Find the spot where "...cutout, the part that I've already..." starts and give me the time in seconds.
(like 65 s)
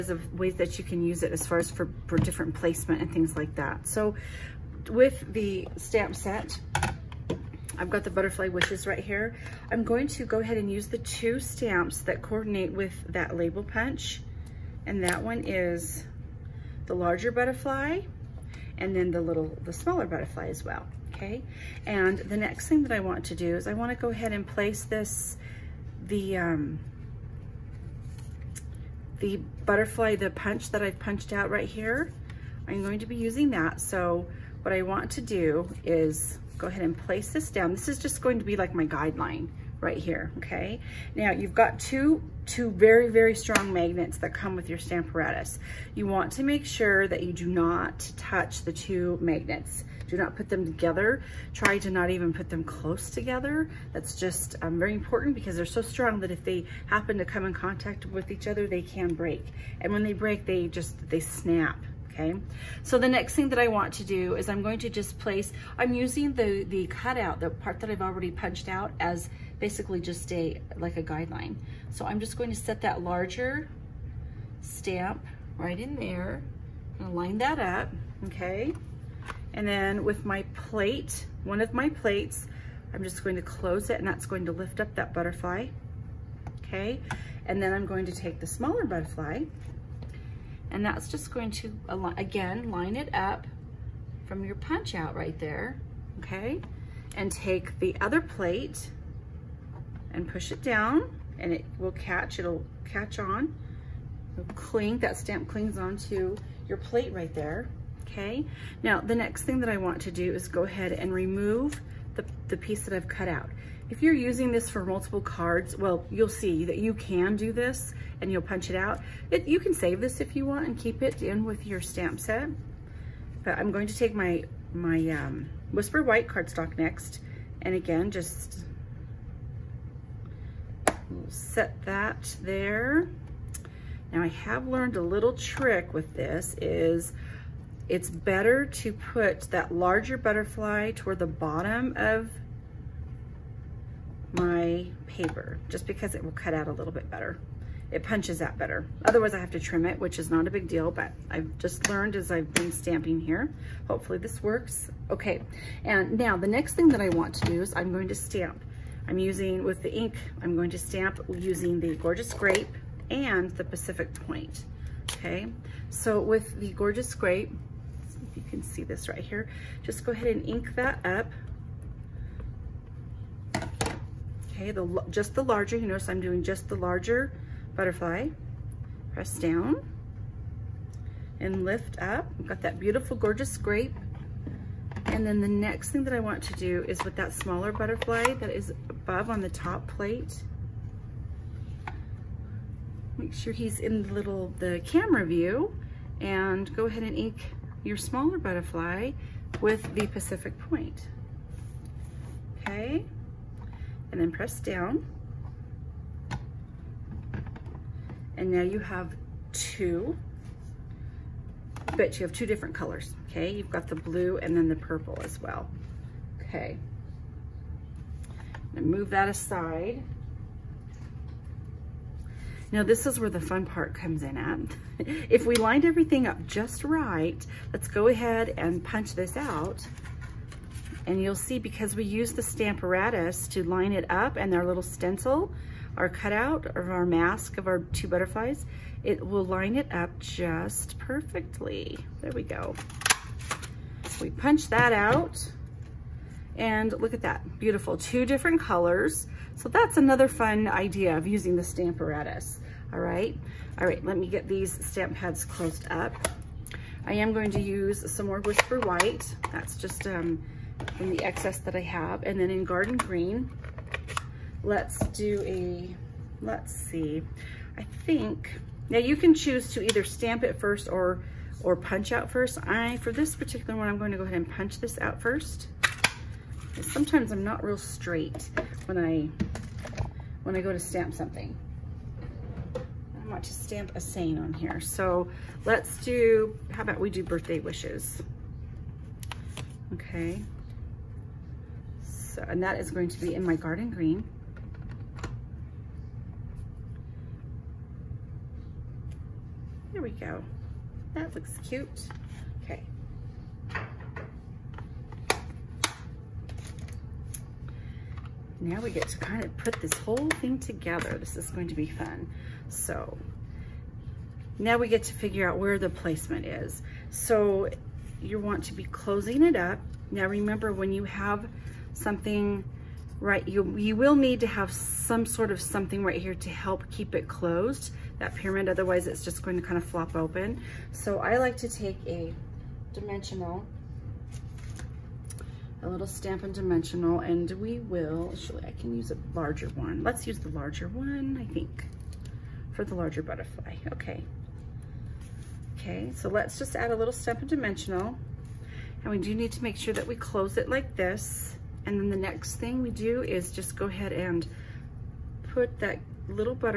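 66 s.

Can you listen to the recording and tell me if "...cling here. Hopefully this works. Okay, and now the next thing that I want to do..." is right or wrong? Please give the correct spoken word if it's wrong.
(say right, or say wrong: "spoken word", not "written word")
wrong: "stamping", not "cling".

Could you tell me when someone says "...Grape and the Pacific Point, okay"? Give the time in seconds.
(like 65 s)
162 s.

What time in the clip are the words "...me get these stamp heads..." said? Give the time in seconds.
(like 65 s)
254 s.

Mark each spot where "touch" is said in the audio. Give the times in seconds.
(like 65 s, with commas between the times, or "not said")
48 s.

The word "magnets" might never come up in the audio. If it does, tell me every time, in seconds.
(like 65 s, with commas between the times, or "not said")
43 s, 49 s.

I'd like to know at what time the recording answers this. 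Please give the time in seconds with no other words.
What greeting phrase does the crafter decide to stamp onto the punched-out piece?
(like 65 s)
287 s.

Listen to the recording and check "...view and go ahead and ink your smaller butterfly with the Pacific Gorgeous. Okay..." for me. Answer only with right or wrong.
wrong.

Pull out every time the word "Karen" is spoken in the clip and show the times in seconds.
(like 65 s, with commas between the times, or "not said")
not said.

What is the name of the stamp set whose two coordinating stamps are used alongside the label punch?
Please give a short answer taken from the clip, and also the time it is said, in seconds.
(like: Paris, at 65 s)
Butterfly Wishes, at 8 s.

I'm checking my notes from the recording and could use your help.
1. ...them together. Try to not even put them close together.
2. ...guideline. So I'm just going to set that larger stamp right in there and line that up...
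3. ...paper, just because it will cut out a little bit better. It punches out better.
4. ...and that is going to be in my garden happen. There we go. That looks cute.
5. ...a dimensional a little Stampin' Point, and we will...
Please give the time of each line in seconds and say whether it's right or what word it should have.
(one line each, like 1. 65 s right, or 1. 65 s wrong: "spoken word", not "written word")
1. 50 s right
2. 71 s right
3. 145 s right
4. 292 s wrong: "green", not "happen"
5. 332 s wrong: "Dimensional", not "Point".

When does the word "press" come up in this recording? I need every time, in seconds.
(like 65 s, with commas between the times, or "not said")
179 s, 204 s.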